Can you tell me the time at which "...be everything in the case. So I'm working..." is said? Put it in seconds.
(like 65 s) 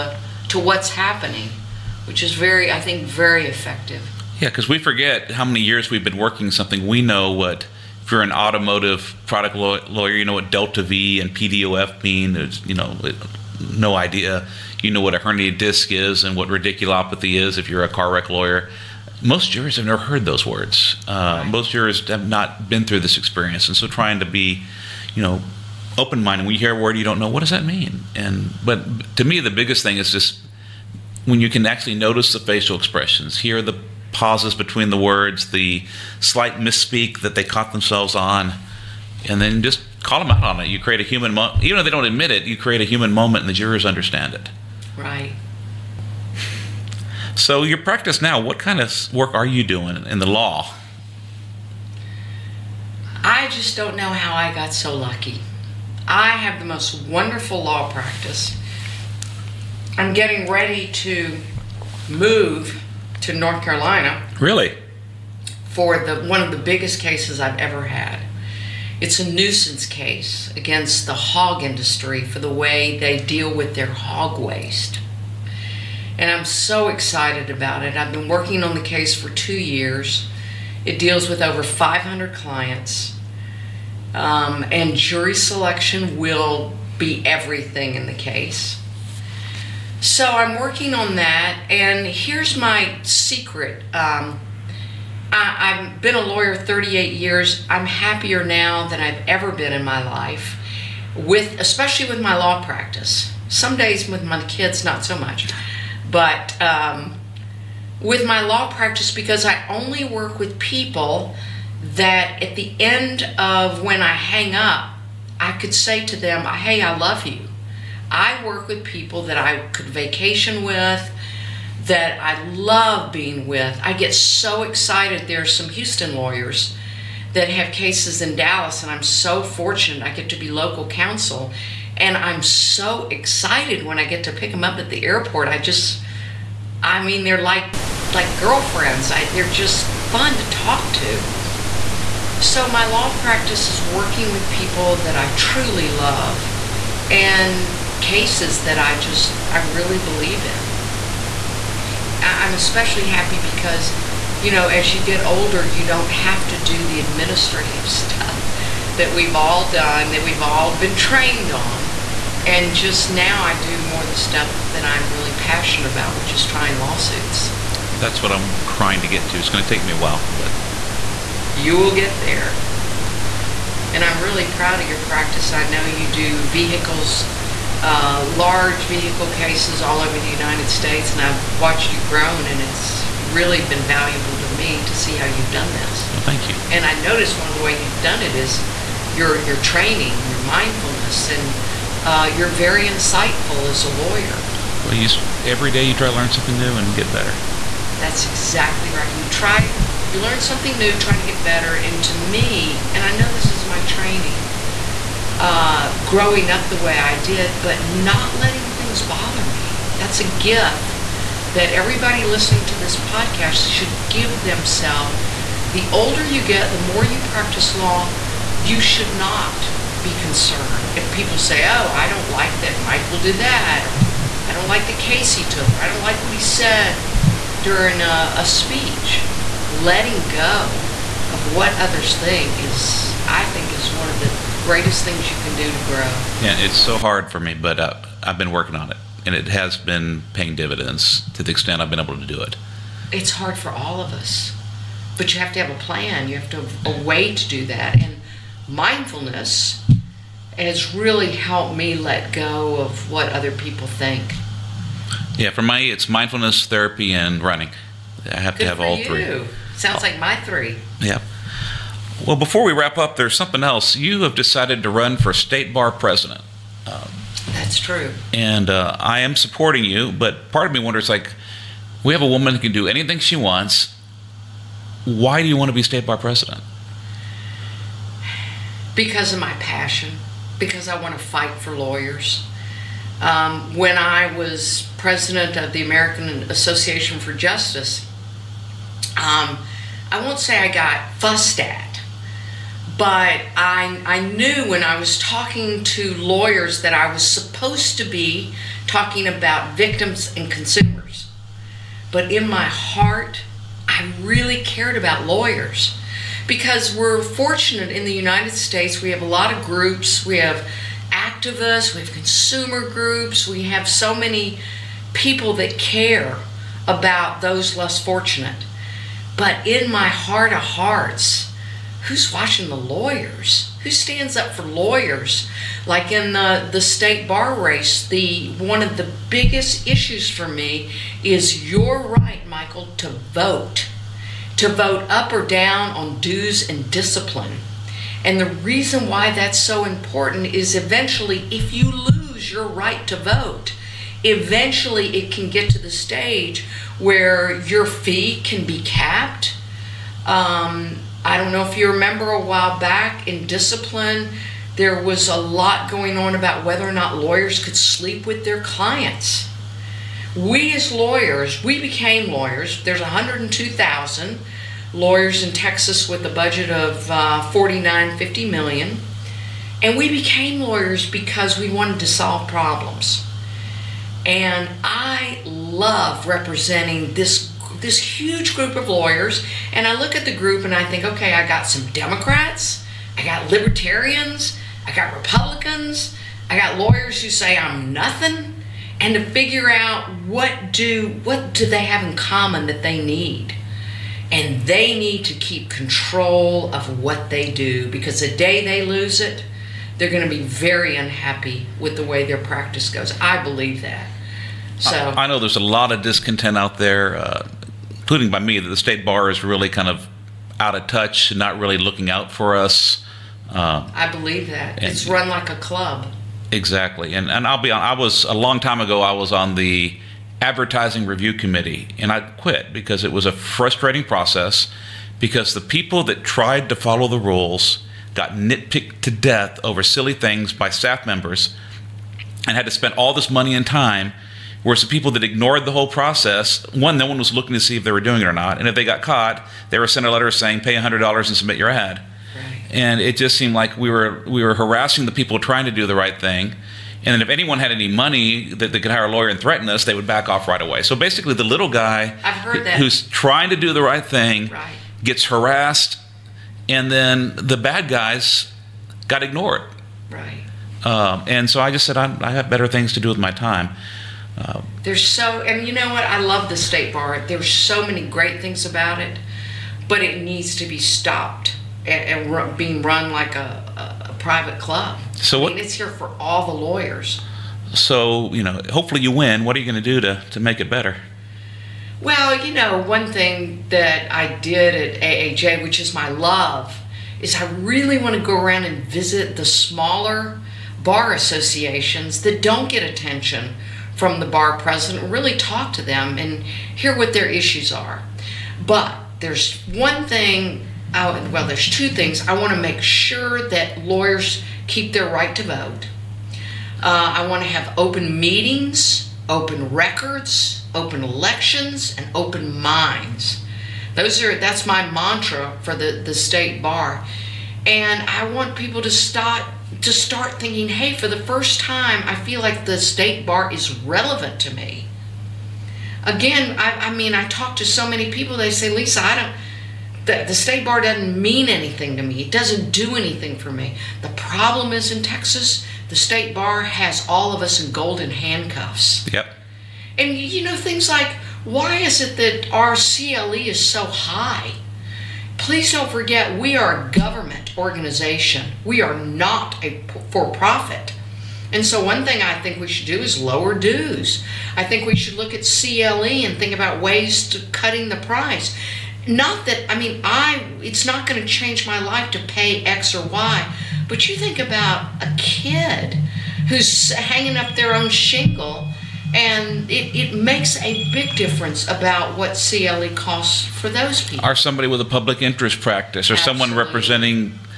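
86 s.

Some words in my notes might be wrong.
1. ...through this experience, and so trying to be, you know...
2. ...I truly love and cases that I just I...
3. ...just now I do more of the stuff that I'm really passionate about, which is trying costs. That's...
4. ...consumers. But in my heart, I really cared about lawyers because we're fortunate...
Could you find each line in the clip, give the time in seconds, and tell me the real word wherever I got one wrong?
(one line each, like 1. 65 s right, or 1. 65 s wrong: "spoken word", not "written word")
1. 22 s right
2. 145 s right
3. 162 s wrong: "lawsuits", not "costs"
4. 300 s right.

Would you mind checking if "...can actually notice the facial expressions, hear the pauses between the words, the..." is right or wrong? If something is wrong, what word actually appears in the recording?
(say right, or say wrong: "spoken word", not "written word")
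right.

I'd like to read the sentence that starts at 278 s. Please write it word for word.
Because of my passion, because I want to fight for lawyers.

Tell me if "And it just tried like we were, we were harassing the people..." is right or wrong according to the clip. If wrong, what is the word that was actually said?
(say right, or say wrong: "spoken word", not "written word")
wrong: "seemed", not "tried".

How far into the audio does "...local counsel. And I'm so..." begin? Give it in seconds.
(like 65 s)
130 s.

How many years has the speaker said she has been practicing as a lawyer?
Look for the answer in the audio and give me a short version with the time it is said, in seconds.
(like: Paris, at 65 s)
38, at 96 s.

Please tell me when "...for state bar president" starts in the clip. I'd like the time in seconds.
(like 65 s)
265 s.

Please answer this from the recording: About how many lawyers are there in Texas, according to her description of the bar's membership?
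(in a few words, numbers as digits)
102,000.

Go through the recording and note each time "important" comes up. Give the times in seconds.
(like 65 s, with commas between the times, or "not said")
339 s.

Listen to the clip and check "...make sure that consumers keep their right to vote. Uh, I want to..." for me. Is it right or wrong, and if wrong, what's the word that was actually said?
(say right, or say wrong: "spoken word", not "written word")
wrong: "lawyers", not "consumers".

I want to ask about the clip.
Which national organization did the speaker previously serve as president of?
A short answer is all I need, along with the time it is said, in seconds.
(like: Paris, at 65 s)
American Association for Justice, at 285 s.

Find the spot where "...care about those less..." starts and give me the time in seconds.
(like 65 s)
315 s.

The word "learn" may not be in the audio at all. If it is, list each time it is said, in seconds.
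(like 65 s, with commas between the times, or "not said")
196 s, 200 s.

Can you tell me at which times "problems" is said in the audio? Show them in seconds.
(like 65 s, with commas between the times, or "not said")
372 s, 534 s.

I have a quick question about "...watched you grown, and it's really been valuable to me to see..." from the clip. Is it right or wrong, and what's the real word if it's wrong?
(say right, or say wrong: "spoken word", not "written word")
right.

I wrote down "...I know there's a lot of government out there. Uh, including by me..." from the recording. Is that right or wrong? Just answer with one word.
wrong.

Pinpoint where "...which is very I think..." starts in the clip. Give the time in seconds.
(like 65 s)
2 s.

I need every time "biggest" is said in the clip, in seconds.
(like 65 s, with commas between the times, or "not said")
29 s, 66 s, 329 s.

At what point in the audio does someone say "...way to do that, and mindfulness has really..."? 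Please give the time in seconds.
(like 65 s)
247 s.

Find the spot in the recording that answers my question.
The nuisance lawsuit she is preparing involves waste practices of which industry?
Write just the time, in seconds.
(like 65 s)
71 s.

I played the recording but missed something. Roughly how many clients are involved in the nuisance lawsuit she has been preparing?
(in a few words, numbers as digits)
over 500.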